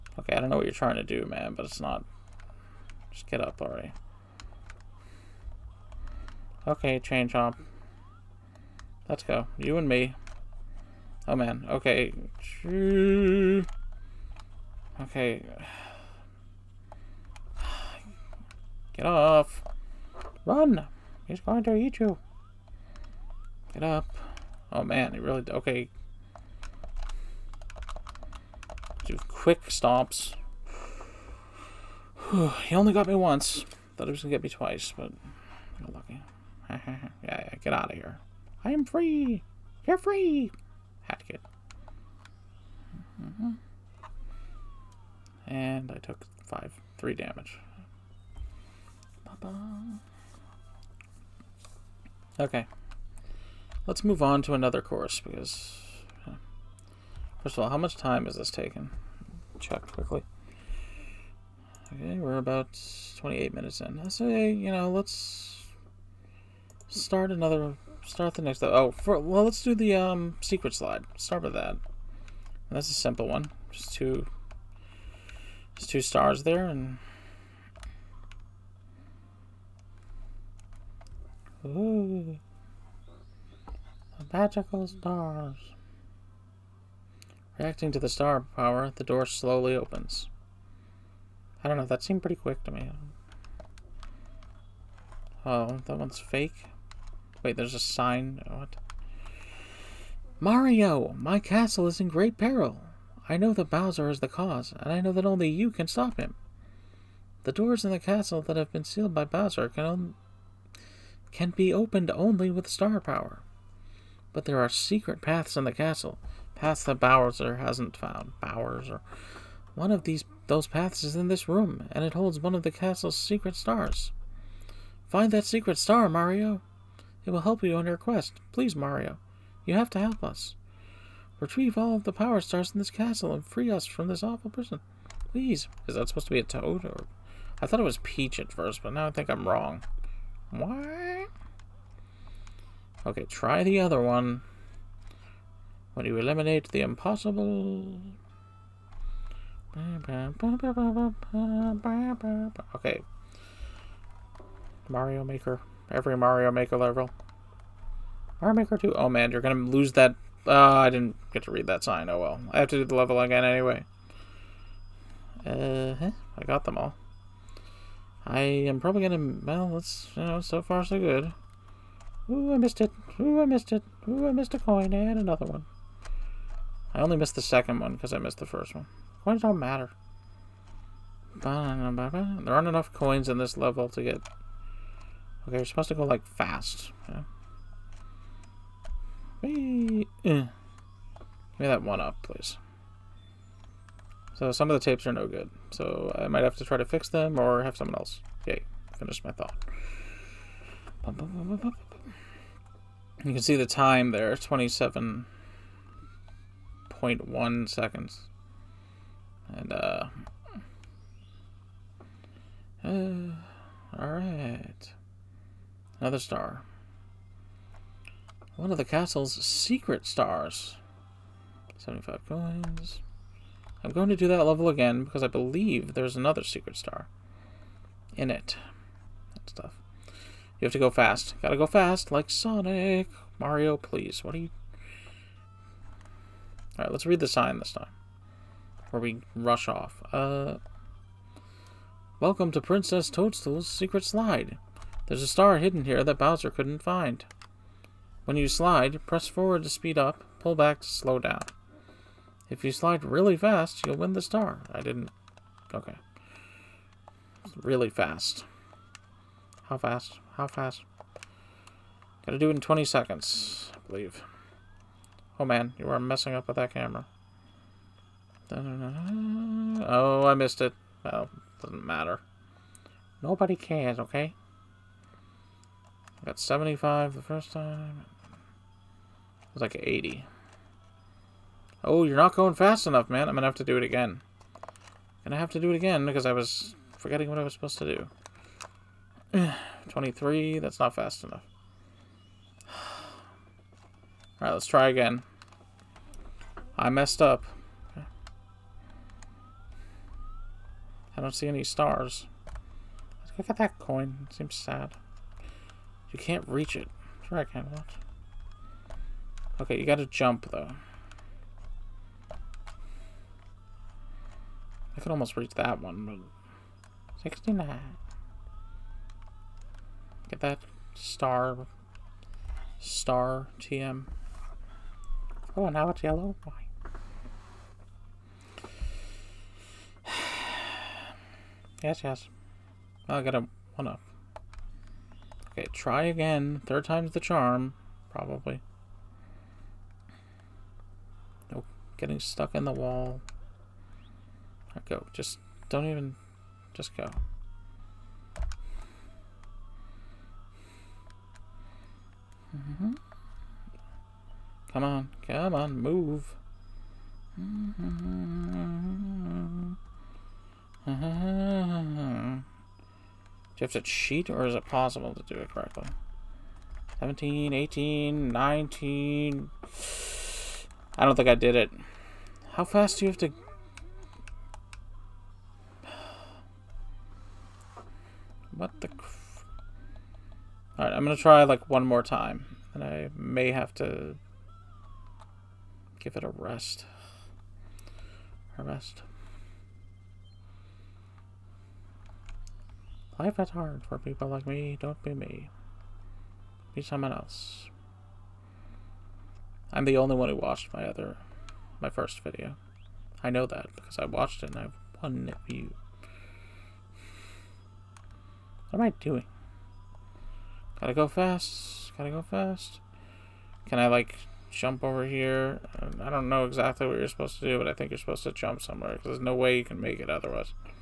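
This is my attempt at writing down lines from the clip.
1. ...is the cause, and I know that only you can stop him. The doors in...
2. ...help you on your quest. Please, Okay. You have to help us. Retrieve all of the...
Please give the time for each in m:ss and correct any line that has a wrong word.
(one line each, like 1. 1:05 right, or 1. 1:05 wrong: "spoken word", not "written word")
1. 1:44 right
2. 2:07 wrong: "Mario", not "Okay".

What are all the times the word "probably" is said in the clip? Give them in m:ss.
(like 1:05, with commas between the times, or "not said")
2:48, 5:38.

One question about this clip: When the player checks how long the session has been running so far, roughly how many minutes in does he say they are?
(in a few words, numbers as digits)
28 minutes.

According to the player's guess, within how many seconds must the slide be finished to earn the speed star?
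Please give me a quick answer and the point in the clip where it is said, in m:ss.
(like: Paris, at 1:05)
20 seconds, at 4:22.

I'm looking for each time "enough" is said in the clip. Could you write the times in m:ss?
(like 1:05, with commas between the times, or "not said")
3:02, 4:42, 4:51.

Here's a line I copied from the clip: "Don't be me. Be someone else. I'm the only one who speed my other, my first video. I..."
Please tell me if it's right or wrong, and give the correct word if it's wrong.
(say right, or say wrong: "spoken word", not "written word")
wrong: "watched", not "speed".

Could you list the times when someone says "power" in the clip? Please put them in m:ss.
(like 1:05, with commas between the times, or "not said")
1:28, 1:52, 2:12.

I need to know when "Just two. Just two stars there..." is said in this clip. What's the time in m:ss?
1:13.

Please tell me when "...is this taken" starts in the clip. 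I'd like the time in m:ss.
0:58.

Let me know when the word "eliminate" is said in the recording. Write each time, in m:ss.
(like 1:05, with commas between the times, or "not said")
2:26.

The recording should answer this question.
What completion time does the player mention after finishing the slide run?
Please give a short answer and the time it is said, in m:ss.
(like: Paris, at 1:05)
27.1 seconds, at 3:24.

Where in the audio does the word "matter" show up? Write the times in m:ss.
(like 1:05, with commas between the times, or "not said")
2:59, 4:31.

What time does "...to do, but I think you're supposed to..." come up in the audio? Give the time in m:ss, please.
6:57.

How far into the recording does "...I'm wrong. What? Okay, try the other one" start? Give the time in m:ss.
2:19.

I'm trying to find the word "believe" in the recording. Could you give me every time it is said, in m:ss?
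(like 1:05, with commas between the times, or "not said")
3:45, 4:23.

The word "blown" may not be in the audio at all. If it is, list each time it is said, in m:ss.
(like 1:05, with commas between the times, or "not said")
not said.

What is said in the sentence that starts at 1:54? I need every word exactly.
But there are secret paths in the castle, paths that Bowser hasn't found.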